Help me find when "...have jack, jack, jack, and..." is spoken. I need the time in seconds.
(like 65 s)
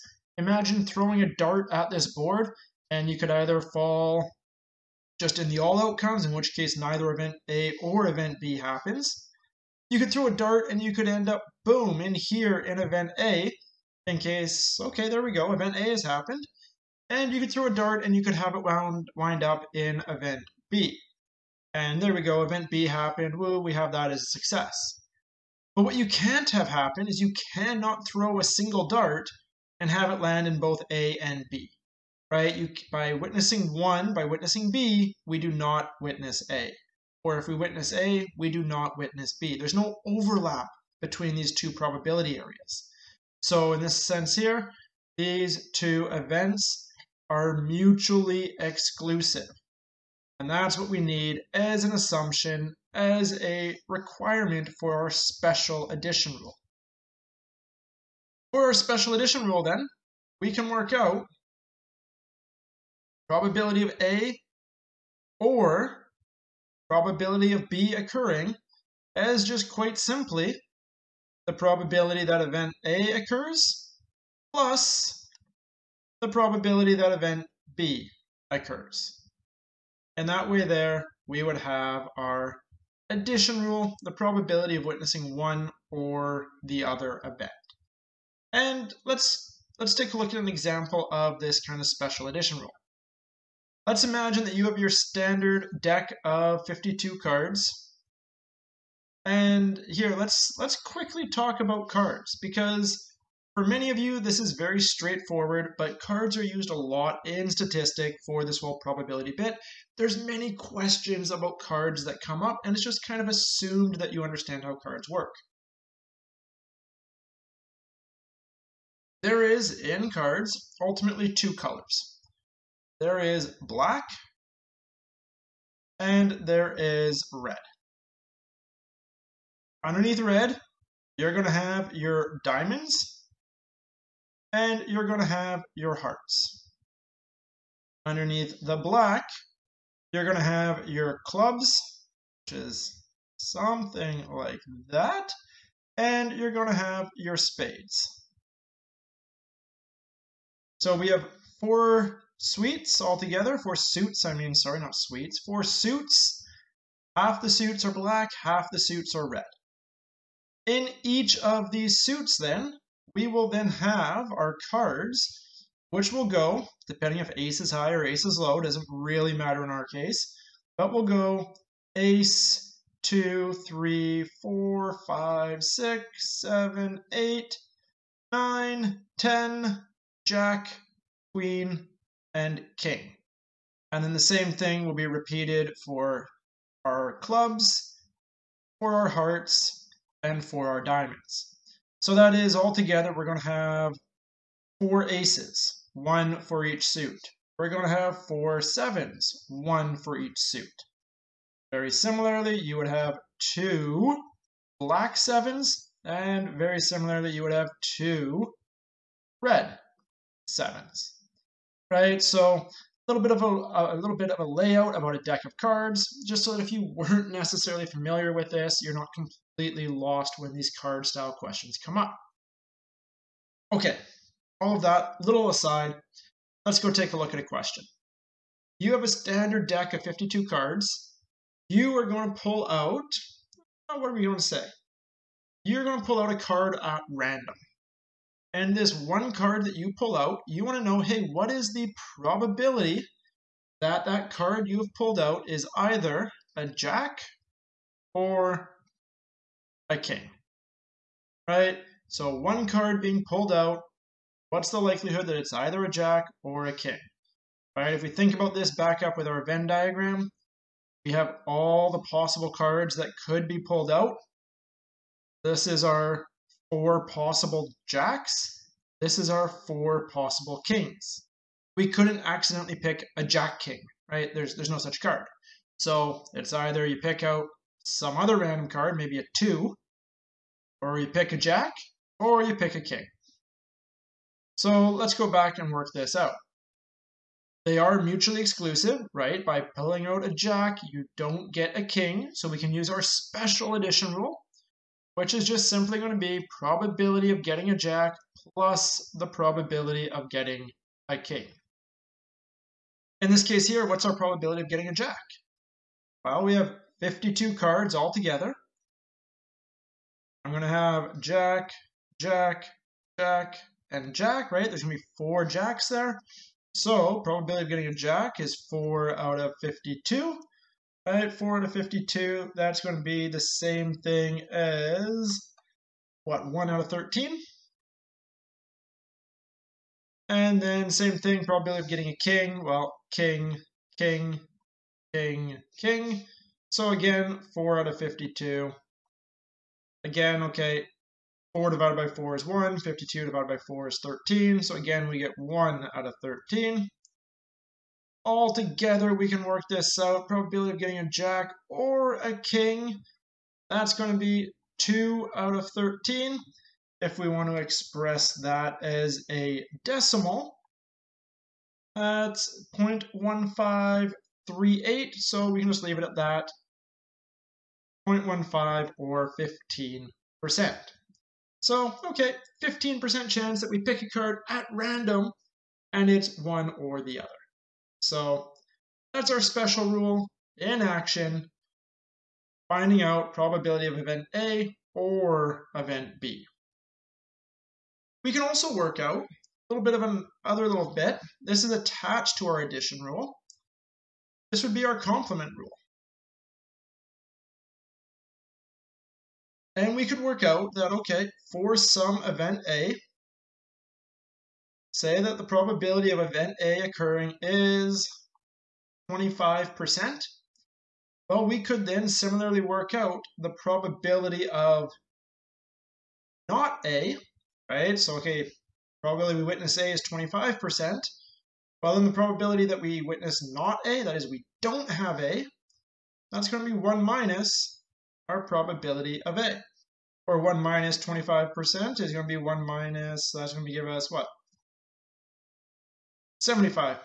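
310 s.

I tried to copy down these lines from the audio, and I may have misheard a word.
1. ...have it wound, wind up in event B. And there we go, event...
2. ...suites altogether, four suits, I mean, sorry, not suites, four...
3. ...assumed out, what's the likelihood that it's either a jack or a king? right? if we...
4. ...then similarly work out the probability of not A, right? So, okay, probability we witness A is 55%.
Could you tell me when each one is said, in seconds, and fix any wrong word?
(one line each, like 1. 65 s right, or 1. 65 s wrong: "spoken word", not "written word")
1. 18 s right
2. 152 s right
3. 253 s wrong: "pulled", not "assumed"
4. 411 s wrong: "25", not "55".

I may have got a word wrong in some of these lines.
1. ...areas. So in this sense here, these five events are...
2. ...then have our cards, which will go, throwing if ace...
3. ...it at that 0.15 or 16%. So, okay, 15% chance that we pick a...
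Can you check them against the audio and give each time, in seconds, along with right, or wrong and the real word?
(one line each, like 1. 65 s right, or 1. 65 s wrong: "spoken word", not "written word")
1. 42 s wrong: "two", not "five"
2. 163 s wrong: "depending", not "throwing"
3. 365 s wrong: "15", not "16".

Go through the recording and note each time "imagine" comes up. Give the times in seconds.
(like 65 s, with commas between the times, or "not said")
0 s, 94 s.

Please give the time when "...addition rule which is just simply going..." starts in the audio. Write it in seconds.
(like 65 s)
293 s.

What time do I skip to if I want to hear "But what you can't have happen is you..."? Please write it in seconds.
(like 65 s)
25 s.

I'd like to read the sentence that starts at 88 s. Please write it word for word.
And let's, let's take a look at an example of this kind of special addition rule.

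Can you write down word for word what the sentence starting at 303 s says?
In this case here, what's our probability of getting a jack?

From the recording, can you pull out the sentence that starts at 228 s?
You have a standard deck of 52 cards.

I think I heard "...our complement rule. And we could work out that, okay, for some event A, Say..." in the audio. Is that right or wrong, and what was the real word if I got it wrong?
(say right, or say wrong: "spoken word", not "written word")
right.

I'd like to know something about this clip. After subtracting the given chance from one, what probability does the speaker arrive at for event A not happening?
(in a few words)
75%.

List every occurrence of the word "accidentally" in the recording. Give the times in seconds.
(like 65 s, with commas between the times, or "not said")
272 s.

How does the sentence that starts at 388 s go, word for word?
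We can also work out a little bit of an other little bit.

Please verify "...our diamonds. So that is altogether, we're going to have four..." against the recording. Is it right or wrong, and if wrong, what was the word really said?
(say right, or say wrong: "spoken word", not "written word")
right.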